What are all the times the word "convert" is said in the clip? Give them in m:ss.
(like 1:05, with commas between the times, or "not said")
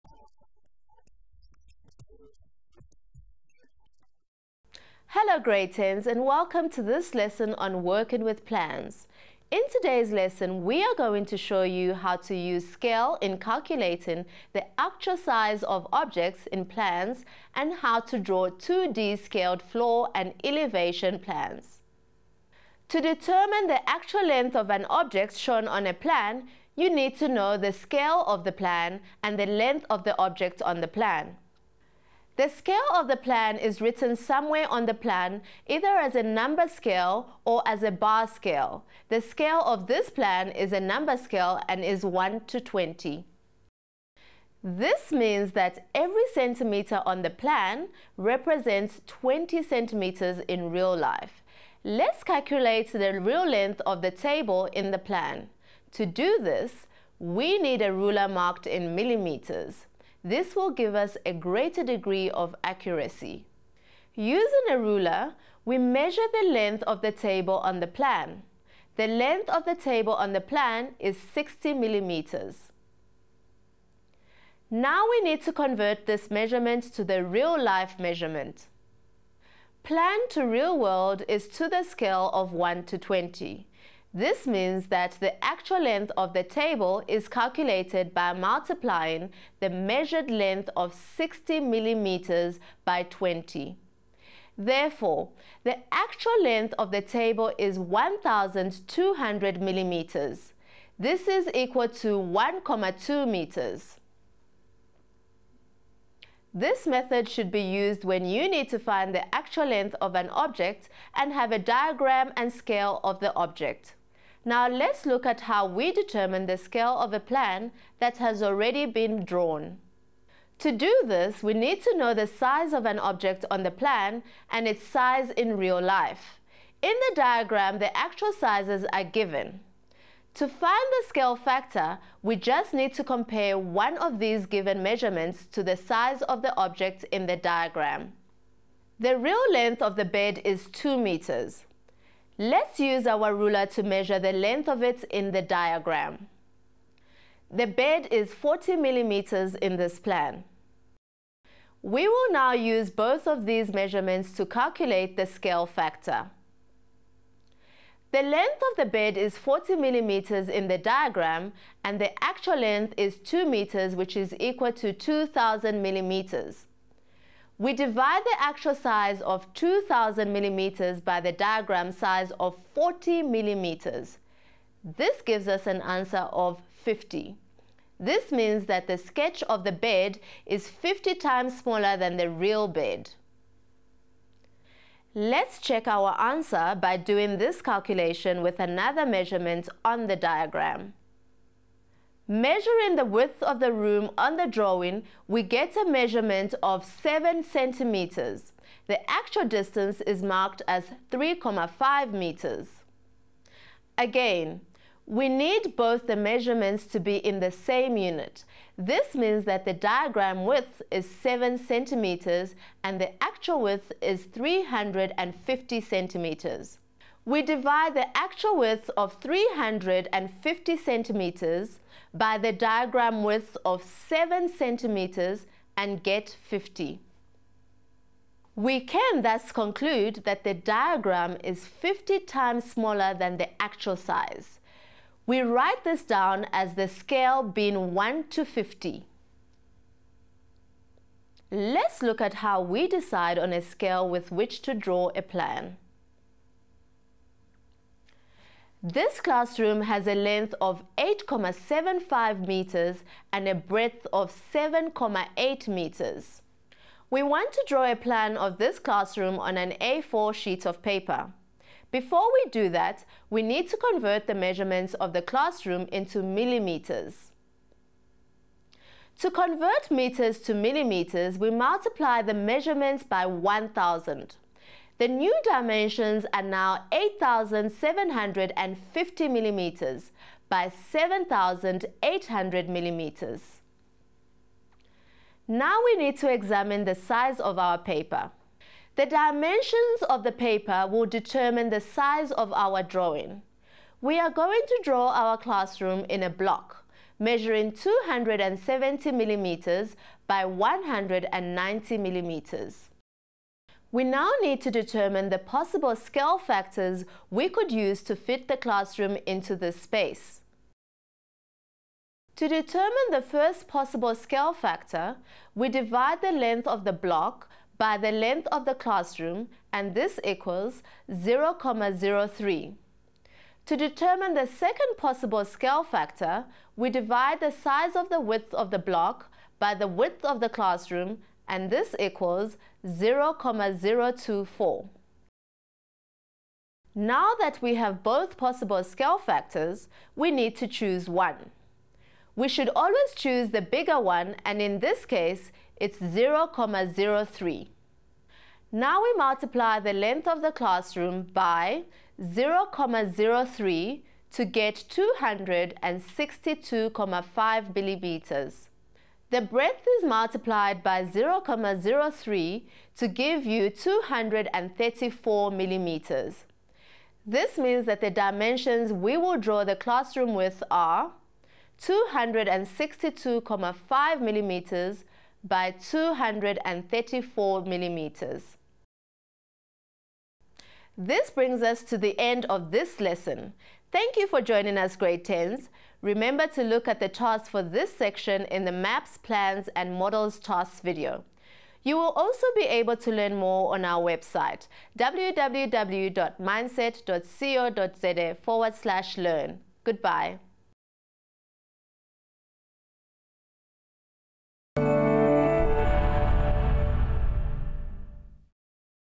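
1:15, 4:23, 4:29.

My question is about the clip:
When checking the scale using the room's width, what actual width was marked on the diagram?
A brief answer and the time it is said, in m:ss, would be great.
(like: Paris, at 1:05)
3,5 meters, at 3:21.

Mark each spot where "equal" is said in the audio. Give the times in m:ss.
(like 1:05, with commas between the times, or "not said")
1:41, 2:44, 5:20, 5:31.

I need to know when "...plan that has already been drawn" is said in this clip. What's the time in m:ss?
1:57.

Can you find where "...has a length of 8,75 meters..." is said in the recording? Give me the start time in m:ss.
4:09.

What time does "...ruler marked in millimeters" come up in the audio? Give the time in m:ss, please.
0:57.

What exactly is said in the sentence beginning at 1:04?
Using a ruler, we measure the length of the table on the plan.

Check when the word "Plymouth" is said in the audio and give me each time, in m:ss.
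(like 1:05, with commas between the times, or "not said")
not said.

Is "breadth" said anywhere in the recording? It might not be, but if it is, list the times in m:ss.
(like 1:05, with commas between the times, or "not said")
4:13, 5:59.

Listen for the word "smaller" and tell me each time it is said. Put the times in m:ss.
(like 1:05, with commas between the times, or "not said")
3:01, 3:52.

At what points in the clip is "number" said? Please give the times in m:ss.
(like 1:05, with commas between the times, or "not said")
0:36, 0:40.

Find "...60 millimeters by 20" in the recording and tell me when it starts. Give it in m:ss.
1:30.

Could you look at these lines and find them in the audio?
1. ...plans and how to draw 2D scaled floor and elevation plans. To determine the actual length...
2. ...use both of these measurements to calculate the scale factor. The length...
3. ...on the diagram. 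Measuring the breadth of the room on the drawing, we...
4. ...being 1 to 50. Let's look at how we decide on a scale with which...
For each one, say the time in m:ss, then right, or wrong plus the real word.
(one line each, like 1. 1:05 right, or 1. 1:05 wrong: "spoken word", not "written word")
1. 0:16 right
2. 2:32 right
3. 3:09 wrong: "width", not "breadth"
4. 3:57 right.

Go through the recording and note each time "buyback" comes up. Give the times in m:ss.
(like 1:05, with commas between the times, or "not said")
not said.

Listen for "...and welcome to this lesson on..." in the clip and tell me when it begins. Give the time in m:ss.
0:06.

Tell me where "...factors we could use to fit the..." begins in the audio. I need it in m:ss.
5:06.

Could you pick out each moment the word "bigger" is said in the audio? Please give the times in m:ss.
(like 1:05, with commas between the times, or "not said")
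5:43.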